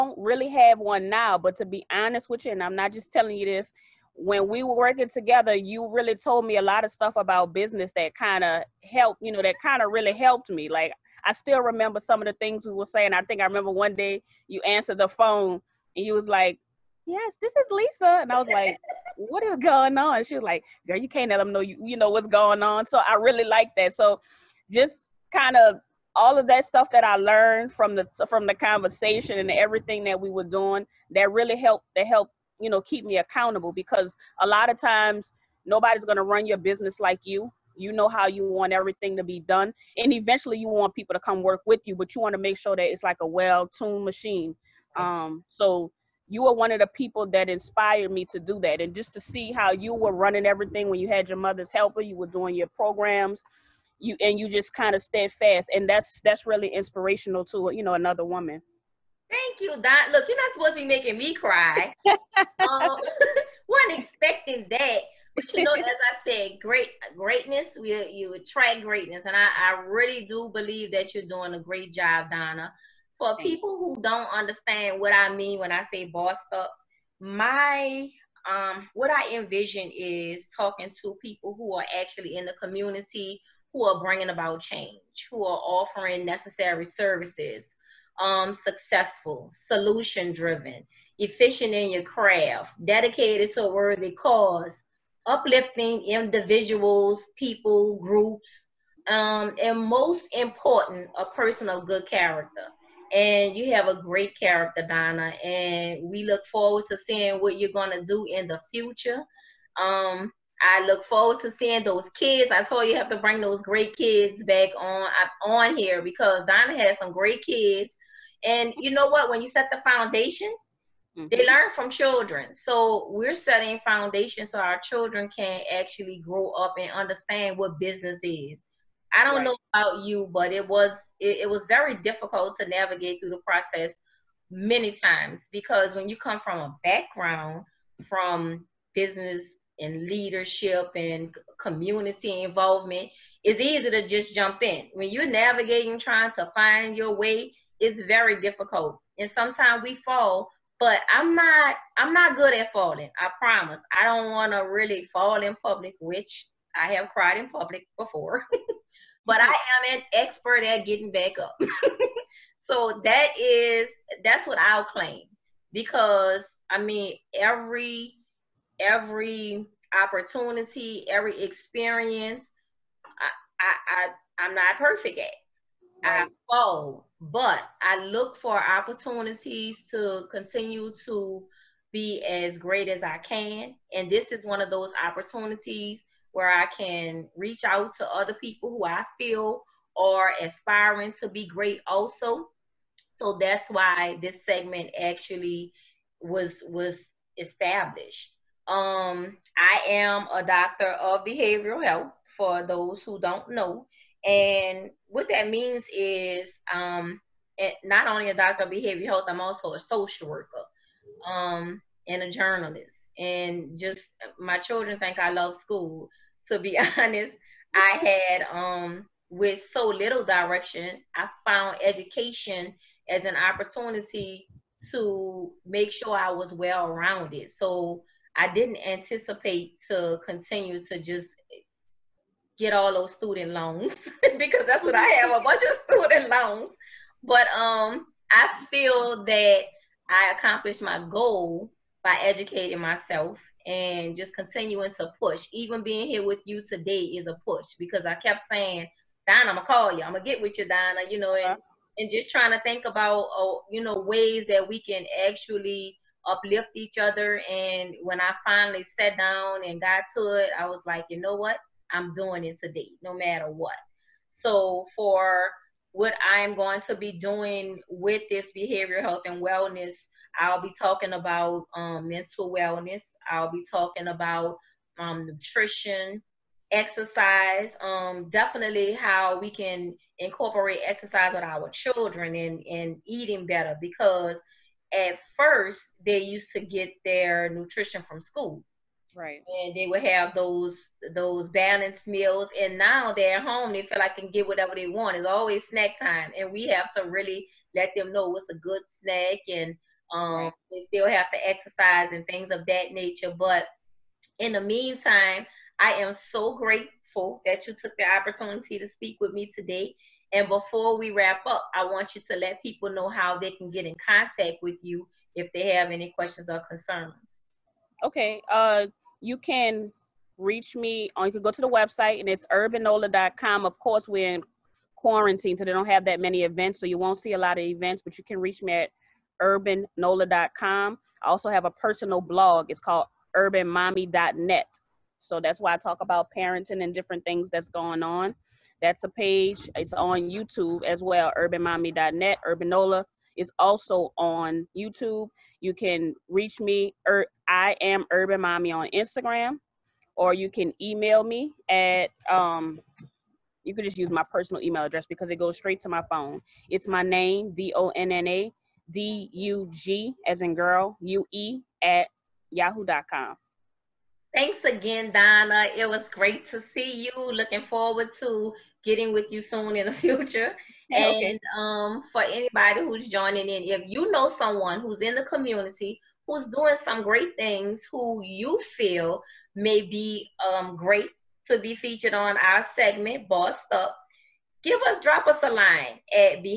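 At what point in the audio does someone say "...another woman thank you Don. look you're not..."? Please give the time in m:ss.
0:57.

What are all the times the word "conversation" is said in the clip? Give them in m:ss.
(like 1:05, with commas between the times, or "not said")
0:28.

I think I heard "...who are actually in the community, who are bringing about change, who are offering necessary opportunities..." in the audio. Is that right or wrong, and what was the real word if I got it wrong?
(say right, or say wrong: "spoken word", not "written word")
wrong: "services", not "opportunities".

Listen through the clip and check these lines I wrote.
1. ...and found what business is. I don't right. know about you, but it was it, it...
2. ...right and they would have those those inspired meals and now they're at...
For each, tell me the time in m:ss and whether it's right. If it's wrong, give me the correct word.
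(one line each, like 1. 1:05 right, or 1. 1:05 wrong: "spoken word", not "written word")
1. 2:06 wrong: "understand", not "found"
2. 4:49 wrong: "balanced", not "inspired".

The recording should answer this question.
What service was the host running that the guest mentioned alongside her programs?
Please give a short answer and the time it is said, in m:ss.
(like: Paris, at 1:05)
mother's helper, at 0:51.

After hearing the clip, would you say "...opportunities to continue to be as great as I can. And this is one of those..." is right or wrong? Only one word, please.
right.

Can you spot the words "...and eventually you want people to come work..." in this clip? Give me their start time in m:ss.
0:39.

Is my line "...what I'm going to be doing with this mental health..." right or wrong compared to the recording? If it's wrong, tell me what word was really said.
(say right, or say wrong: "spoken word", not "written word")
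wrong: "behavioral", not "mental".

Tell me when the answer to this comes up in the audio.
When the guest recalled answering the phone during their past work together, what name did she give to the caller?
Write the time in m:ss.
0:17.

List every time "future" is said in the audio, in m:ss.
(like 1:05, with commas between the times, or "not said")
1:48, 6:09.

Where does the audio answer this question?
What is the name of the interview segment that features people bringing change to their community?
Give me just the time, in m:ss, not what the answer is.
1:16.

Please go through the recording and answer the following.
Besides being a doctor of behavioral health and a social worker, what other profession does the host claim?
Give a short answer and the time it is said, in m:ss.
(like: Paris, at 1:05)
journalist, at 3:32.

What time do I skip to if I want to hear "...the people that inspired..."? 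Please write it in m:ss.
0:46.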